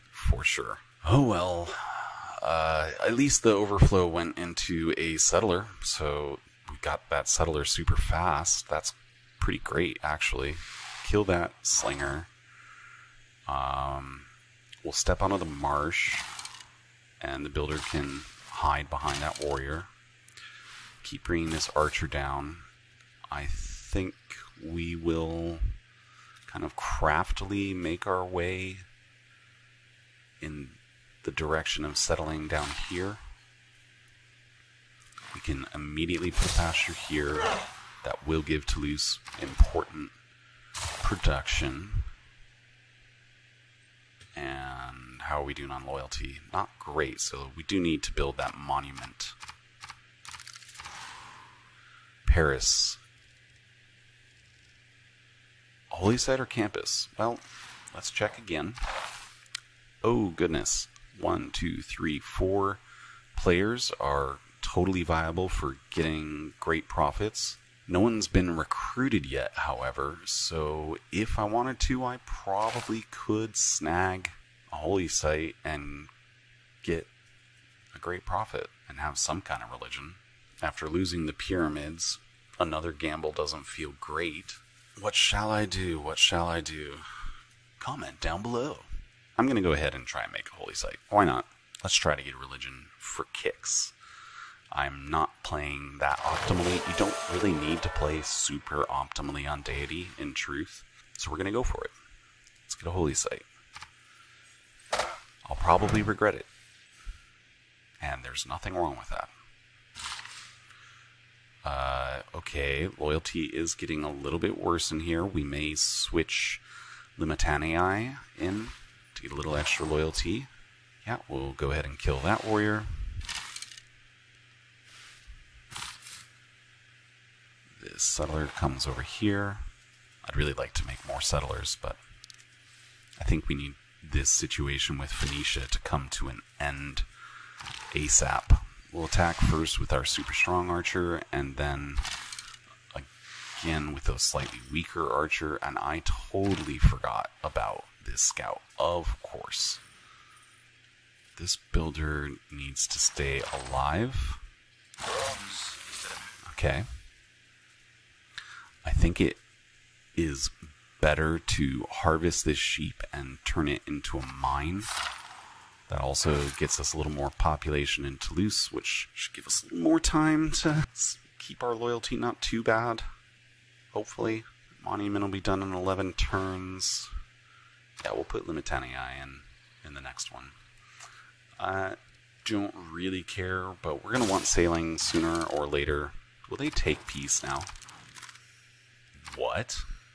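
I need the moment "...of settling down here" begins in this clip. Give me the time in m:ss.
0:31.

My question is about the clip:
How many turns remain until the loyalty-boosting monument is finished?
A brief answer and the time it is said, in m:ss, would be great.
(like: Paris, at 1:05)
11, at 2:55.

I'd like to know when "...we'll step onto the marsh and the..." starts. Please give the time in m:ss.
0:14.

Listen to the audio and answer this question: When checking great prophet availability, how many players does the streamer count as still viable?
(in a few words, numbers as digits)
4.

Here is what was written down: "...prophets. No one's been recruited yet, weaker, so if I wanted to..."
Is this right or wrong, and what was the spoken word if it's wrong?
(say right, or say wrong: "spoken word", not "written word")
wrong: "however", not "weaker".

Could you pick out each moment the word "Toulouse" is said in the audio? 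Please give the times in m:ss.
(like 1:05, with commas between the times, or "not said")
0:38, 2:48.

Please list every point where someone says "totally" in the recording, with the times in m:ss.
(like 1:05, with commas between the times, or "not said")
1:04, 2:26.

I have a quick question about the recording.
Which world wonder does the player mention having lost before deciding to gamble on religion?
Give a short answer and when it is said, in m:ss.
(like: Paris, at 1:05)
Pyramids, at 1:21.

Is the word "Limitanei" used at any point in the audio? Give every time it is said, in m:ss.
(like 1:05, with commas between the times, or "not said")
1:57, 2:58.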